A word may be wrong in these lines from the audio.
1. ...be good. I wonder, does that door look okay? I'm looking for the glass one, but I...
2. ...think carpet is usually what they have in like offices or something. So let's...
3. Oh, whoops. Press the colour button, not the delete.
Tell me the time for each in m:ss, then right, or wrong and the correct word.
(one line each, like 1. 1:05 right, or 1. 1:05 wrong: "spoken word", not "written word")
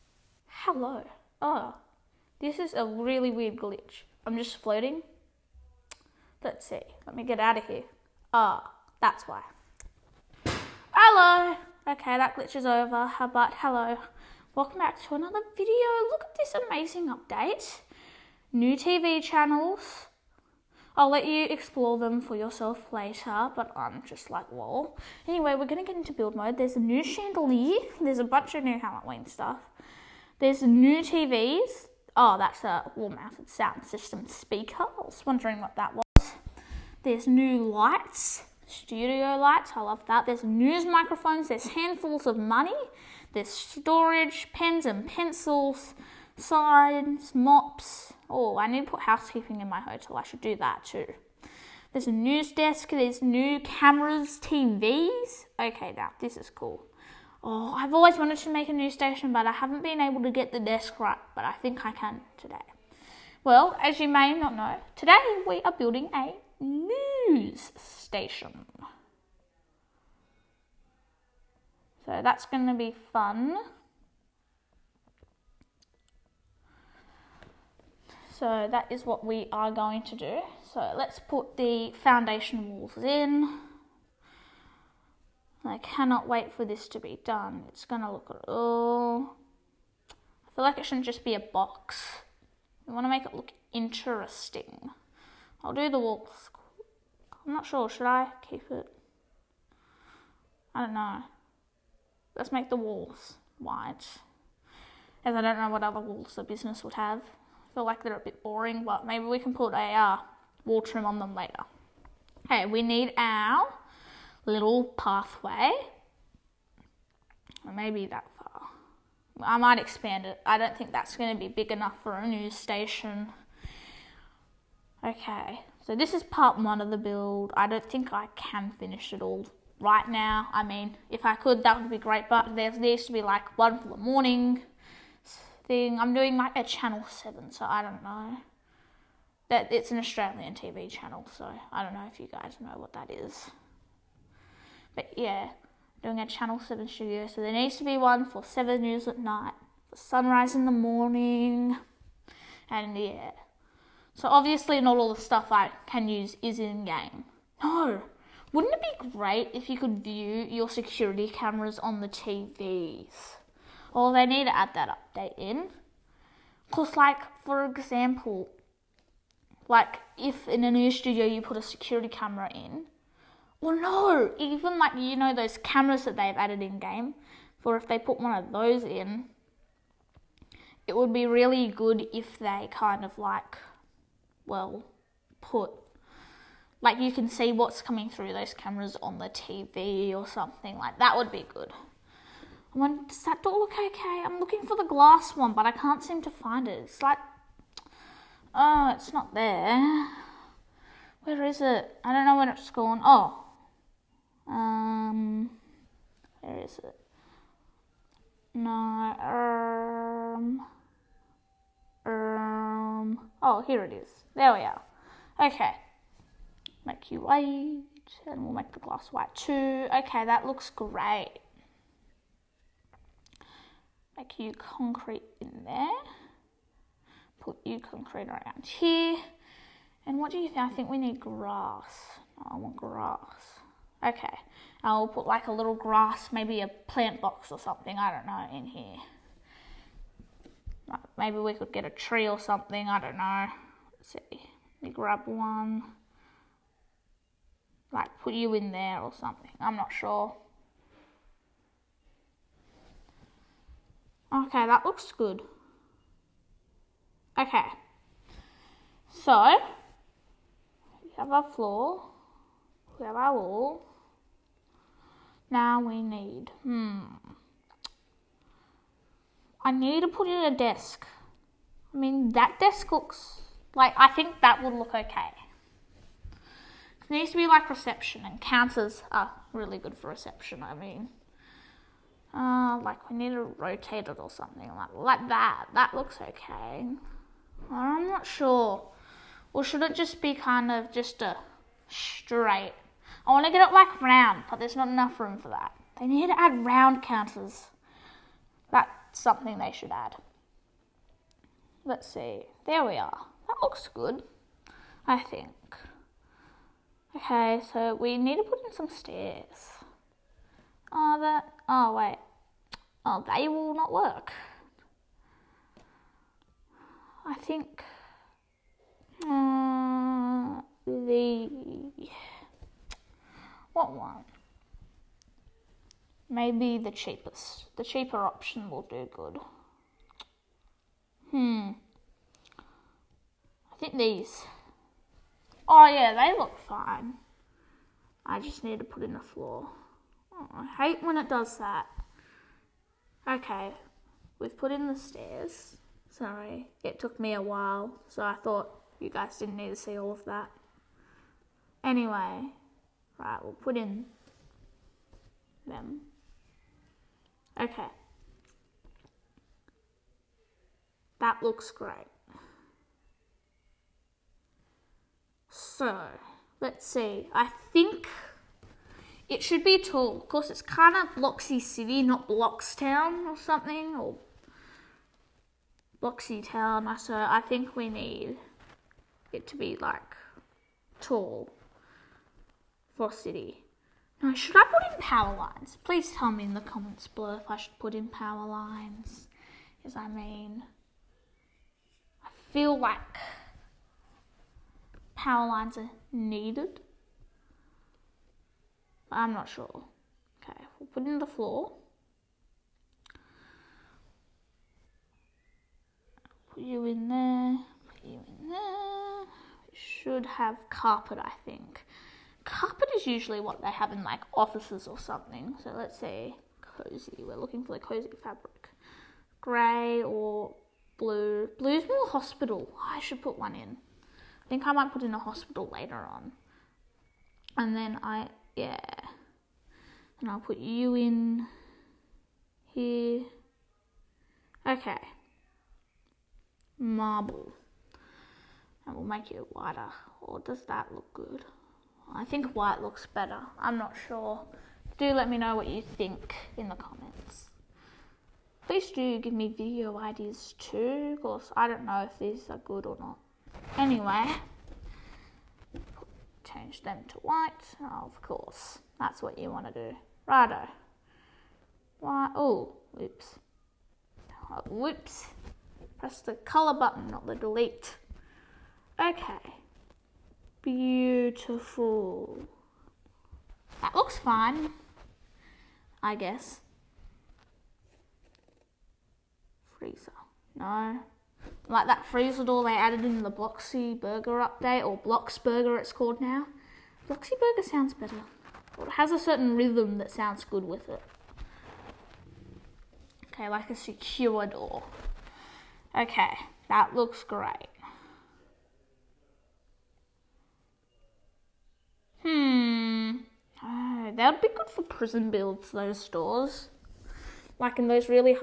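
1. 3:11 right
2. 6:51 right
3. 7:44 right.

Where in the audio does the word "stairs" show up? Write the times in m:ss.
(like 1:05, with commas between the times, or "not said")
5:08, 5:44.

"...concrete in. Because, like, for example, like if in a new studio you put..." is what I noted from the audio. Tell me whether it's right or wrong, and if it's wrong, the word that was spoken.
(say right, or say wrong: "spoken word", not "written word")
wrong: "update", not "concrete".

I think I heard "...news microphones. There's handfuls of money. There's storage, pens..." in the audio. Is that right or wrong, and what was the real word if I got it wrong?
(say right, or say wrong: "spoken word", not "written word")
right.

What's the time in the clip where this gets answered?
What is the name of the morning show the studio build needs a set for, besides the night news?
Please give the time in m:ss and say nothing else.
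2:29.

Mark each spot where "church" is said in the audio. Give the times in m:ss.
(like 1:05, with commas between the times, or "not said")
not said.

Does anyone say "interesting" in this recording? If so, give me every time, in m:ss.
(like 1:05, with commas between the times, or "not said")
1:33.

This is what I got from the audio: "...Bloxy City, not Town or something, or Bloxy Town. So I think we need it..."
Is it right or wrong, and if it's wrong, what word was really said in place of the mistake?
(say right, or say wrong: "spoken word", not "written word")
right.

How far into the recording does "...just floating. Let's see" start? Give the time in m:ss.
0:04.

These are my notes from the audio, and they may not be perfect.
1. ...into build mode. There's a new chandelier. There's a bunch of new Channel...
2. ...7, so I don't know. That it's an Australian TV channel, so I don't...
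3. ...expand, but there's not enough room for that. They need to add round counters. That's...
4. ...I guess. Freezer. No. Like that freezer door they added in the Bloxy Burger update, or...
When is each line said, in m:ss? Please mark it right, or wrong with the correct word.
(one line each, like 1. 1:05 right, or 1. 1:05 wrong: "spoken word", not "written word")
1. 0:25 wrong: "Halloween", not "Channel"
2. 2:17 right
3. 4:54 wrong: "round", not "expand"
4. 7:56 right.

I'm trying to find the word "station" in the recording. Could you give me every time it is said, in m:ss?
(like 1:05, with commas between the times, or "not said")
0:58, 1:07, 2:02.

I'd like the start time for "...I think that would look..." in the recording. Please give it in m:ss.
4:33.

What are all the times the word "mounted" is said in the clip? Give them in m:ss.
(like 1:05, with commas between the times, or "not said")
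0:32.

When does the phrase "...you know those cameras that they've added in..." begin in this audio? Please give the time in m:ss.
2:54.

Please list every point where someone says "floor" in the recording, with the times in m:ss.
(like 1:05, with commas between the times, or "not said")
4:21, 5:39, 6:41.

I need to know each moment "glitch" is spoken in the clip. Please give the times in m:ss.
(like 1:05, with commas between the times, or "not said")
0:03, 0:12.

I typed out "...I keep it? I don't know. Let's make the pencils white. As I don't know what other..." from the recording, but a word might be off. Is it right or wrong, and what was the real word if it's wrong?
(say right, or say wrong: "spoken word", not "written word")
wrong: "walls", not "pencils".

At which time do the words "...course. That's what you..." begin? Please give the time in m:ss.
7:38.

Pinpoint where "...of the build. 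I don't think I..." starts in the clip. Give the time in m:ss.
2:06.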